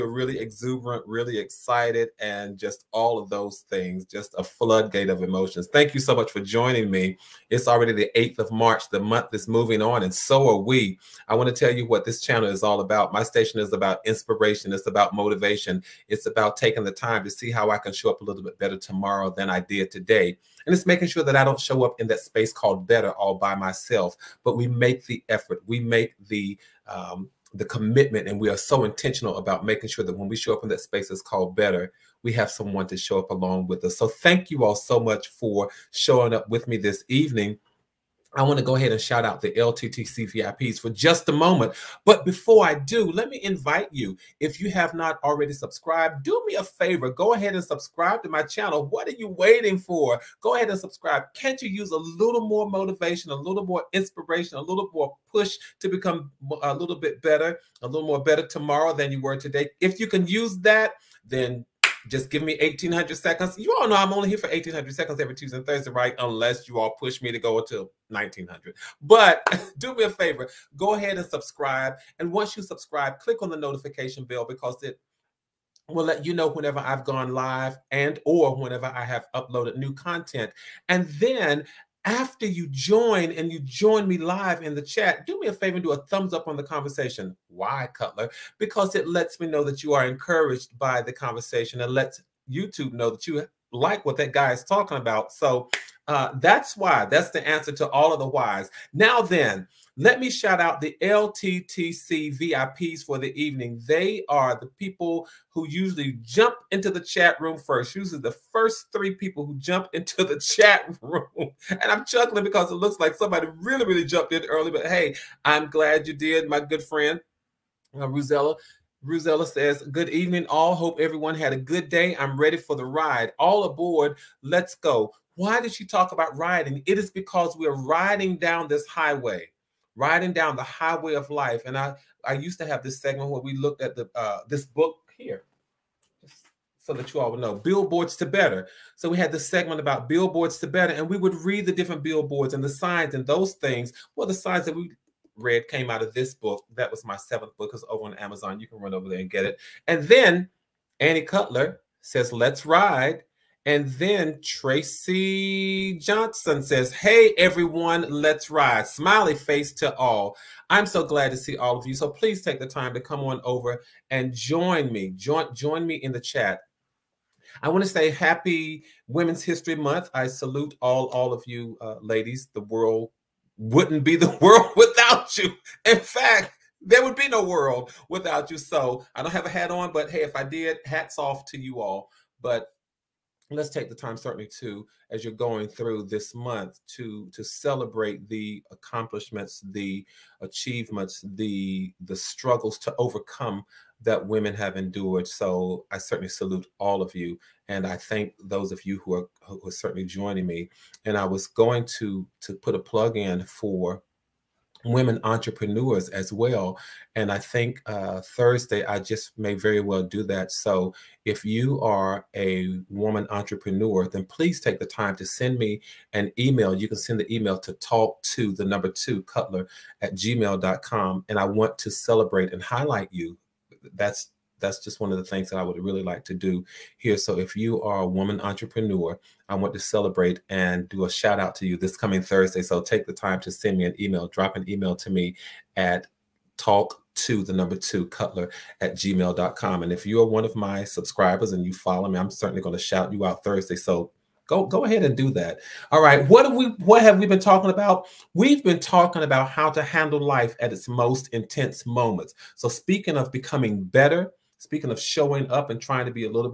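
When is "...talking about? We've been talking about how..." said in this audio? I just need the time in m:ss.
4:07.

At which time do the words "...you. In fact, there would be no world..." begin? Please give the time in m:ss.
2:55.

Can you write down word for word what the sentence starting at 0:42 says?
But before I do, let me invite you, if you have not already subscribed, do me a favor.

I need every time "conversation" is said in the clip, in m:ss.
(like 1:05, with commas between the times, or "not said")
1:26, 1:31.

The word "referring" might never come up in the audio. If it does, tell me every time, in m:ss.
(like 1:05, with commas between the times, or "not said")
not said.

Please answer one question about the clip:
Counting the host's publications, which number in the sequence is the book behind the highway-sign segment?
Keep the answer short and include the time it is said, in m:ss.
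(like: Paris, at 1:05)
seventh, at 2:27.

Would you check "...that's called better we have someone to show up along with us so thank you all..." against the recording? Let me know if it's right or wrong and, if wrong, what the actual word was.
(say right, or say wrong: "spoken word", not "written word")
right.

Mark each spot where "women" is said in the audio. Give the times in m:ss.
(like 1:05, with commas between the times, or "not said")
2:49, 3:14, 3:24.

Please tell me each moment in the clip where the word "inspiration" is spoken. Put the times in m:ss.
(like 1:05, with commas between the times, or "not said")
0:14, 0:53.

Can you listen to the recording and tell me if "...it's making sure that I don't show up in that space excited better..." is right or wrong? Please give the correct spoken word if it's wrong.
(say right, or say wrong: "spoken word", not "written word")
wrong: "called", not "excited".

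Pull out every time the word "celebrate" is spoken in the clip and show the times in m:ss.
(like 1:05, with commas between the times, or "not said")
3:07, 3:41, 3:49.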